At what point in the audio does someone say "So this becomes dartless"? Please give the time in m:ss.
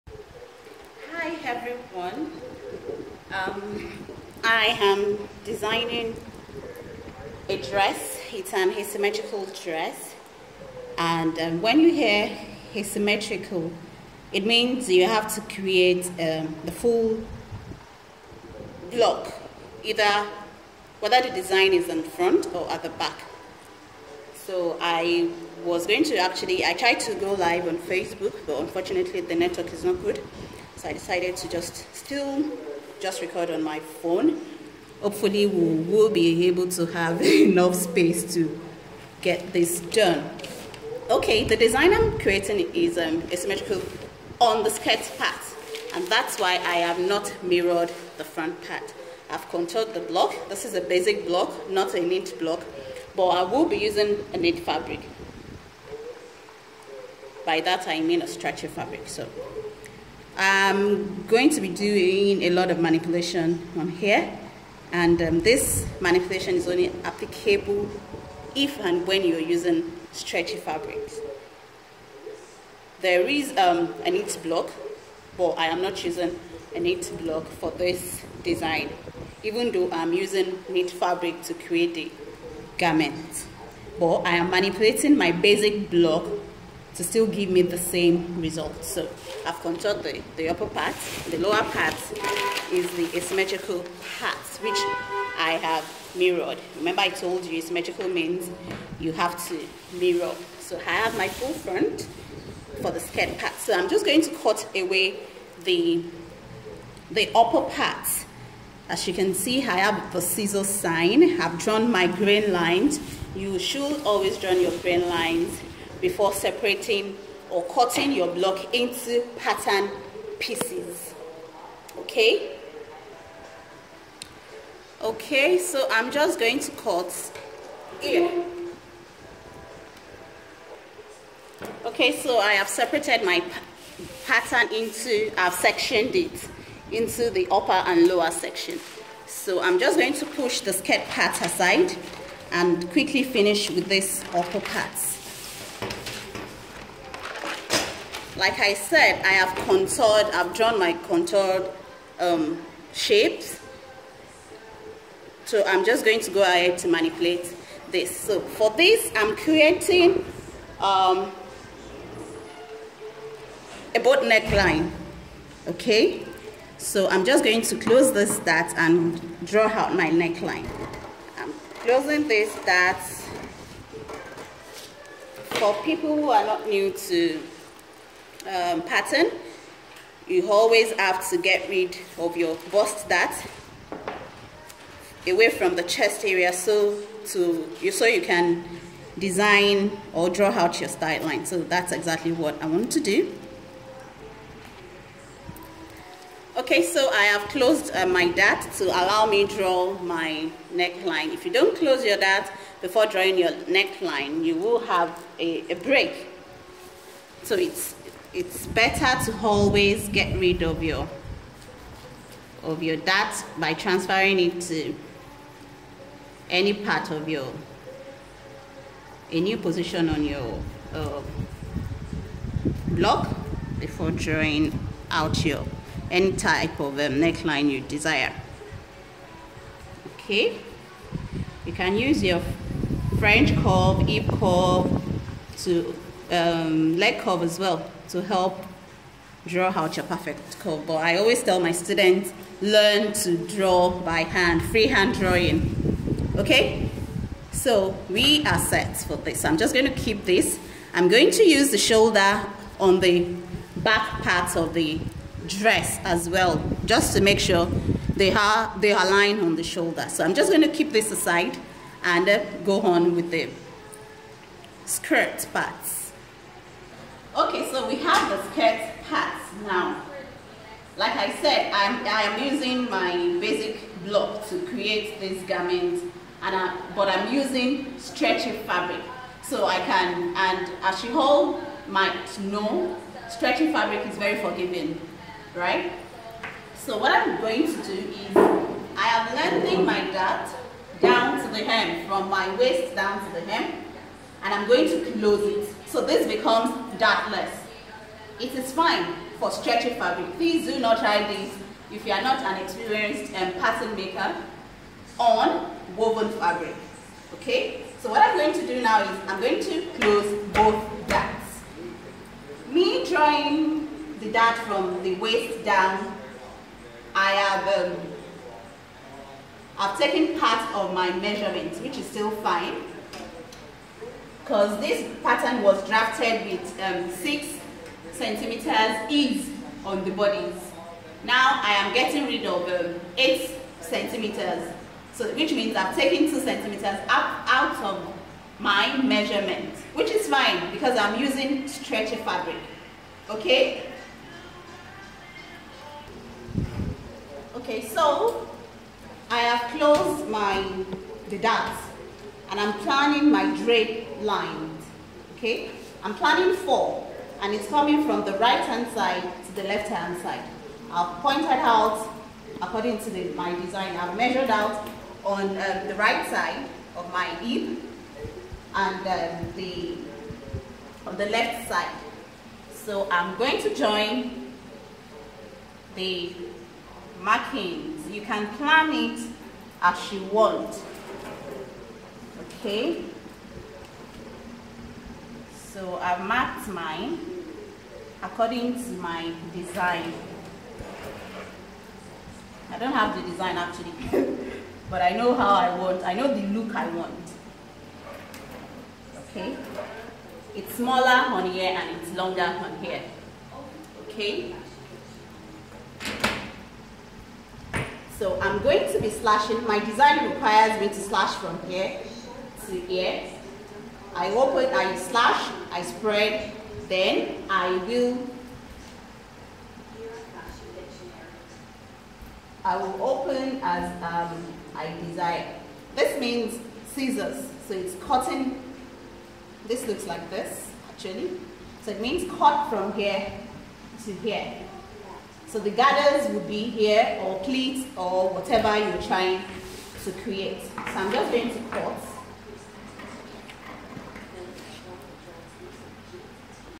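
4:55.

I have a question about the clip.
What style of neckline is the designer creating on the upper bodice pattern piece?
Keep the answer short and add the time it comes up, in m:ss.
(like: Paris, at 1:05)
Boat neckline, at 2:43.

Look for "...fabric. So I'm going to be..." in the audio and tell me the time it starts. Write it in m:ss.
0:58.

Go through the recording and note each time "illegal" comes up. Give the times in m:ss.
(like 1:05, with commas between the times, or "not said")
not said.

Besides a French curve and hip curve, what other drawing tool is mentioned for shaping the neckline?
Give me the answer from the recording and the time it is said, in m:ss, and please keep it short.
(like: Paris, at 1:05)
Leg curve, at 3:56.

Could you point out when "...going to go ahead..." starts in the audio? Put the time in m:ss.
2:36.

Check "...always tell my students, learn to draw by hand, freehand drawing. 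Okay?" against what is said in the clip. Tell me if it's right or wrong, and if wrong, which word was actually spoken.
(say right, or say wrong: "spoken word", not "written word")
right.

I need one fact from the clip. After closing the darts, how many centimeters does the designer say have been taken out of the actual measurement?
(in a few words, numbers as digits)
2 centimeters.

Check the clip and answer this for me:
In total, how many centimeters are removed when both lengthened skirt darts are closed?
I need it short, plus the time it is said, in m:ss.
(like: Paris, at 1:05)
8 centimeters, at 5:33.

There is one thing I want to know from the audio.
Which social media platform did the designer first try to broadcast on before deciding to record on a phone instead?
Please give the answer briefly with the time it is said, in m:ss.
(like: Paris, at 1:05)
Facebook, at 0:27.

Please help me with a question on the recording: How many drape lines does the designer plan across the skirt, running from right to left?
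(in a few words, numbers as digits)
Four.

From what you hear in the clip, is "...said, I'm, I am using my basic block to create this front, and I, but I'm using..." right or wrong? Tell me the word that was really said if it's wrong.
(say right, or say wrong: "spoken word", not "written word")
wrong: "garment", not "front".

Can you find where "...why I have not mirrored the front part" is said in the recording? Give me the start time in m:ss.
0:46.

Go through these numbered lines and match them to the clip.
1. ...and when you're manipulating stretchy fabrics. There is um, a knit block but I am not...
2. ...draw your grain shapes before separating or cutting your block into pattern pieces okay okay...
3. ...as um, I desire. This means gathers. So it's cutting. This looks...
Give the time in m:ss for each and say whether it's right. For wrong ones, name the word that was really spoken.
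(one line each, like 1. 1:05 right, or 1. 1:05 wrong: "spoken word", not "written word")
1. 1:08 wrong: "using", not "manipulating"
2. 1:54 wrong: "lines", not "shapes"
3. 7:03 wrong: "scissors", not "gathers".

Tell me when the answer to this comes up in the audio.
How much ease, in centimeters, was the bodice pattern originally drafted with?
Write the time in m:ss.
5:27.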